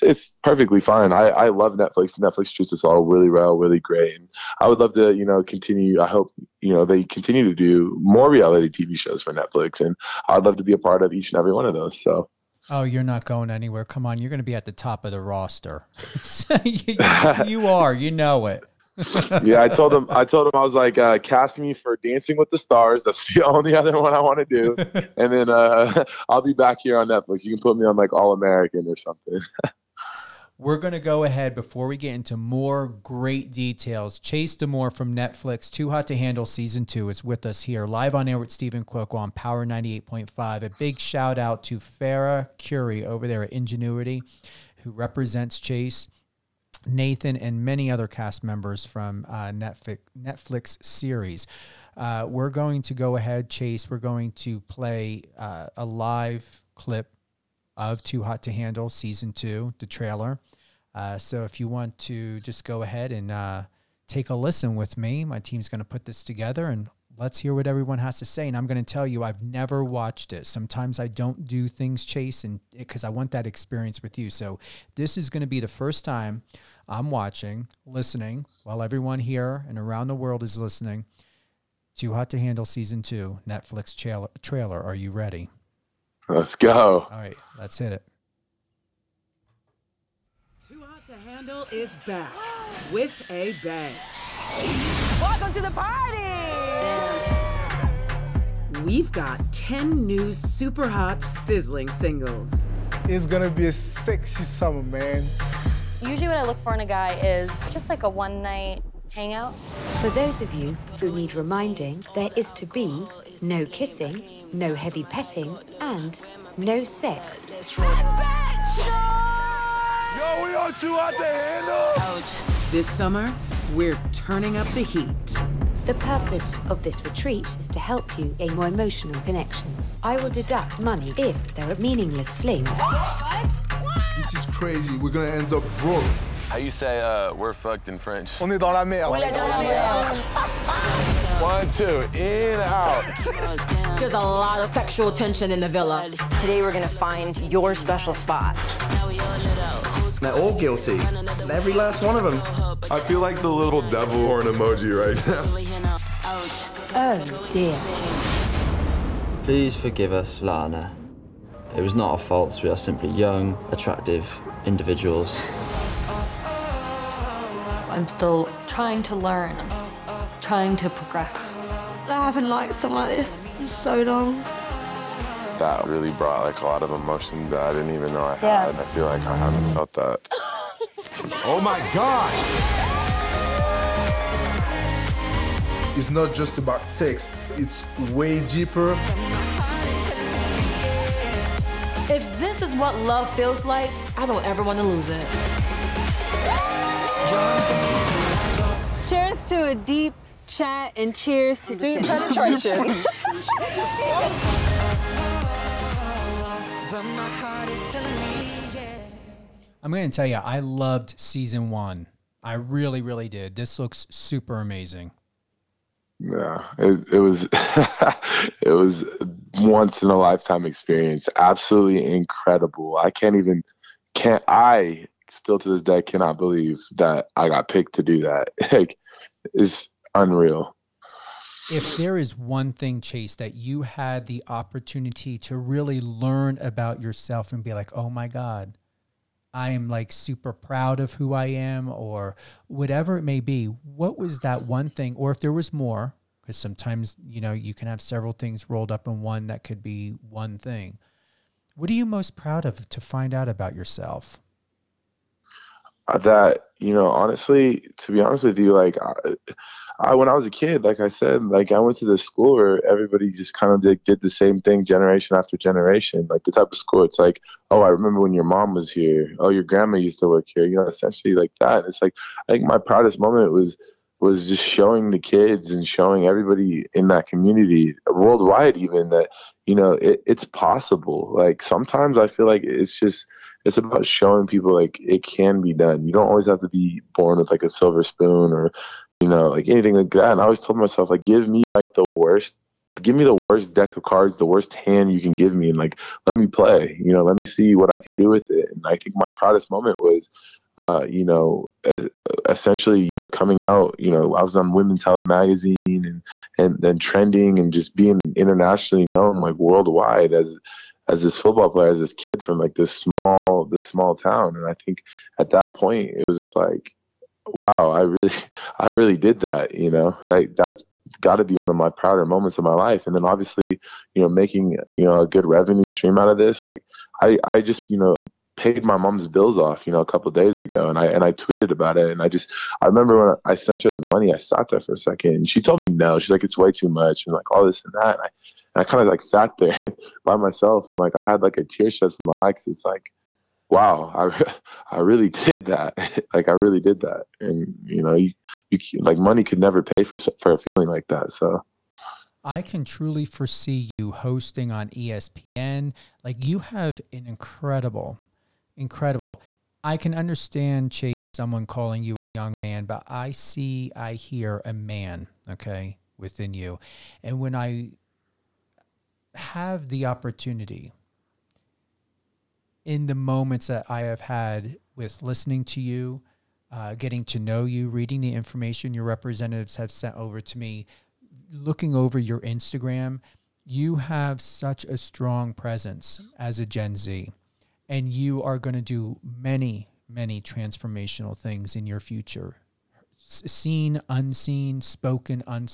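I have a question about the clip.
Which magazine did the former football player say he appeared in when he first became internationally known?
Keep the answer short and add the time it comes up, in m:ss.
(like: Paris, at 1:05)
Women's Health, at 5:04.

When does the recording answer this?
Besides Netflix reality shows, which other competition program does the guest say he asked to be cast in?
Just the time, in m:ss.
0:21.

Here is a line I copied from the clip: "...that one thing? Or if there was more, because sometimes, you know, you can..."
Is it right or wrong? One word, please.
right.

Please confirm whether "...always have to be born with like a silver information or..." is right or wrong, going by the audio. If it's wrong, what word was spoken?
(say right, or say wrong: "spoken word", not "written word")
wrong: "spoon", not "information".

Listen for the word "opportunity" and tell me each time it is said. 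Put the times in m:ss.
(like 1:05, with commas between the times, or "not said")
3:54, 6:10.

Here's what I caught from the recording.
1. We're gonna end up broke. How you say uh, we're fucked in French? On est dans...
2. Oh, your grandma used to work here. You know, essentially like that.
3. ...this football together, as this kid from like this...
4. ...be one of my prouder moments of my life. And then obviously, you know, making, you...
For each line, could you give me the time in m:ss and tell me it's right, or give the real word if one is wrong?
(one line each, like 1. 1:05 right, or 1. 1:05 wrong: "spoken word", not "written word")
1. 2:14 right
2. 4:29 right
3. 5:11 wrong: "player", not "together"
4. 5:21 right.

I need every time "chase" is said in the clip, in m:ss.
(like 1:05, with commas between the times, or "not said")
0:34, 0:45, 0:53, 1:12, 3:52, 6:00.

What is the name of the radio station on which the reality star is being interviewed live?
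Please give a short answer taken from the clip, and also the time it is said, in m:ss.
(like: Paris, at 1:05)
Power 98.5, at 0:39.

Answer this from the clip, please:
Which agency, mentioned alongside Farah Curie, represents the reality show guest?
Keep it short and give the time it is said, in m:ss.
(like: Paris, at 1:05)
Ingenuity, at 0:43.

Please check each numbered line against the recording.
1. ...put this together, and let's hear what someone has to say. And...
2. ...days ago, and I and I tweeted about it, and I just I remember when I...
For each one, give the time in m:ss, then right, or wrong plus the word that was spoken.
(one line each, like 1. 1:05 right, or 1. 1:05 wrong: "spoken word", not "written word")
1. 1:05 wrong: "everyone", not "someone"
2. 5:30 right.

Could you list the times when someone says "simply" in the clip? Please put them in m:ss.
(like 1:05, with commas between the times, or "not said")
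2:42.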